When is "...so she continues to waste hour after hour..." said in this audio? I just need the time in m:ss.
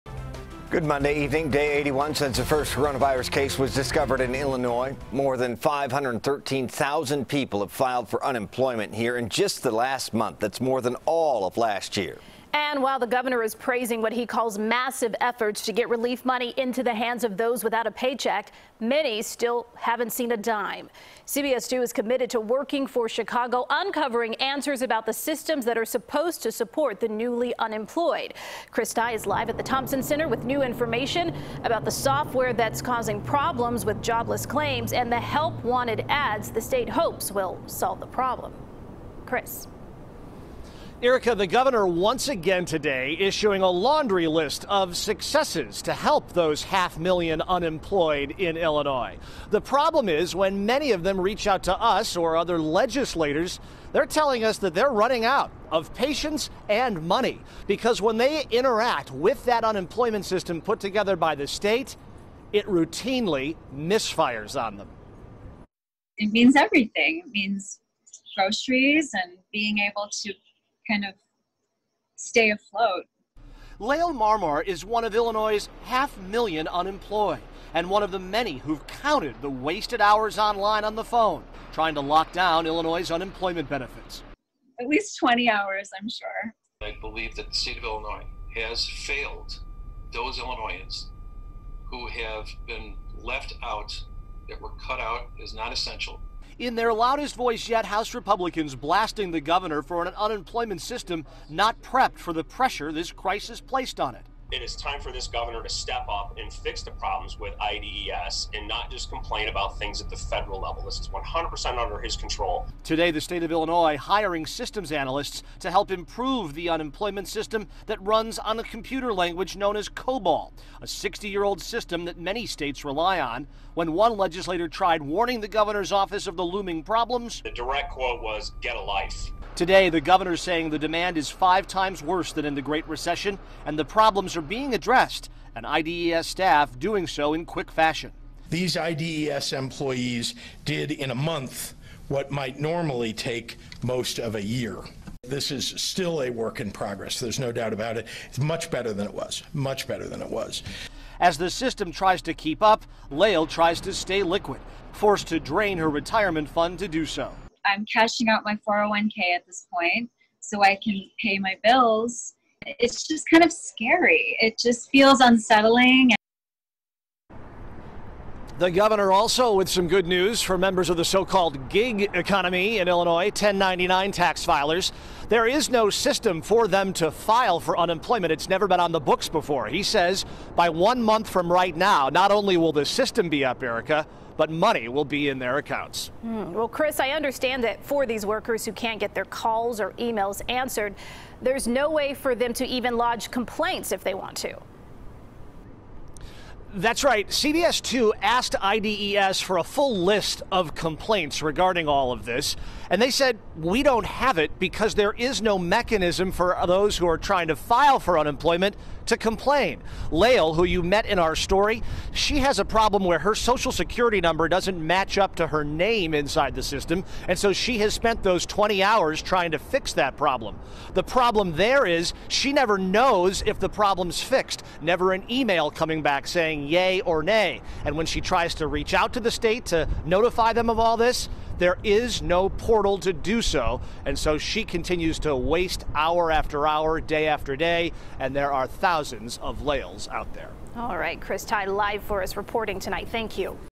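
3:54.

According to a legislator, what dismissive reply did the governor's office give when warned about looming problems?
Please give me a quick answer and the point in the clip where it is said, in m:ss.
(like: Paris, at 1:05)
Get a life, at 2:08.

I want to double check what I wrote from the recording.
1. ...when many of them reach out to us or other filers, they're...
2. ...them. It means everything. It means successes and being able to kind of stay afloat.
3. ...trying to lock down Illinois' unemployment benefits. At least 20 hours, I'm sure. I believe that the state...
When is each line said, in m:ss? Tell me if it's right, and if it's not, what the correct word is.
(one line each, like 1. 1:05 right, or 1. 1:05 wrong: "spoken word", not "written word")
1. 0:50 wrong: "legislators", not "filers"
2. 1:04 wrong: "groceries", not "successes"
3. 1:21 right.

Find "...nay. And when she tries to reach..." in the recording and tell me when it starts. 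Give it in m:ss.
3:47.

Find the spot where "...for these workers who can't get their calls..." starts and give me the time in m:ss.
3:07.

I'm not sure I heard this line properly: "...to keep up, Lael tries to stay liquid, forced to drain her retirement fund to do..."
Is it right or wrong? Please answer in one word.
right.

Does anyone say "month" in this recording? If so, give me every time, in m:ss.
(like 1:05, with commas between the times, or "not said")
0:10, 2:21, 3:01.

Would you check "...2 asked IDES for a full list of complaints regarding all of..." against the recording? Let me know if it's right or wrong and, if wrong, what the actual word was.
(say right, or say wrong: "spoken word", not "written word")
right.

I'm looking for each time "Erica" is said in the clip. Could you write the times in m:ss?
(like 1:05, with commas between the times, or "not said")
0:41, 3:03.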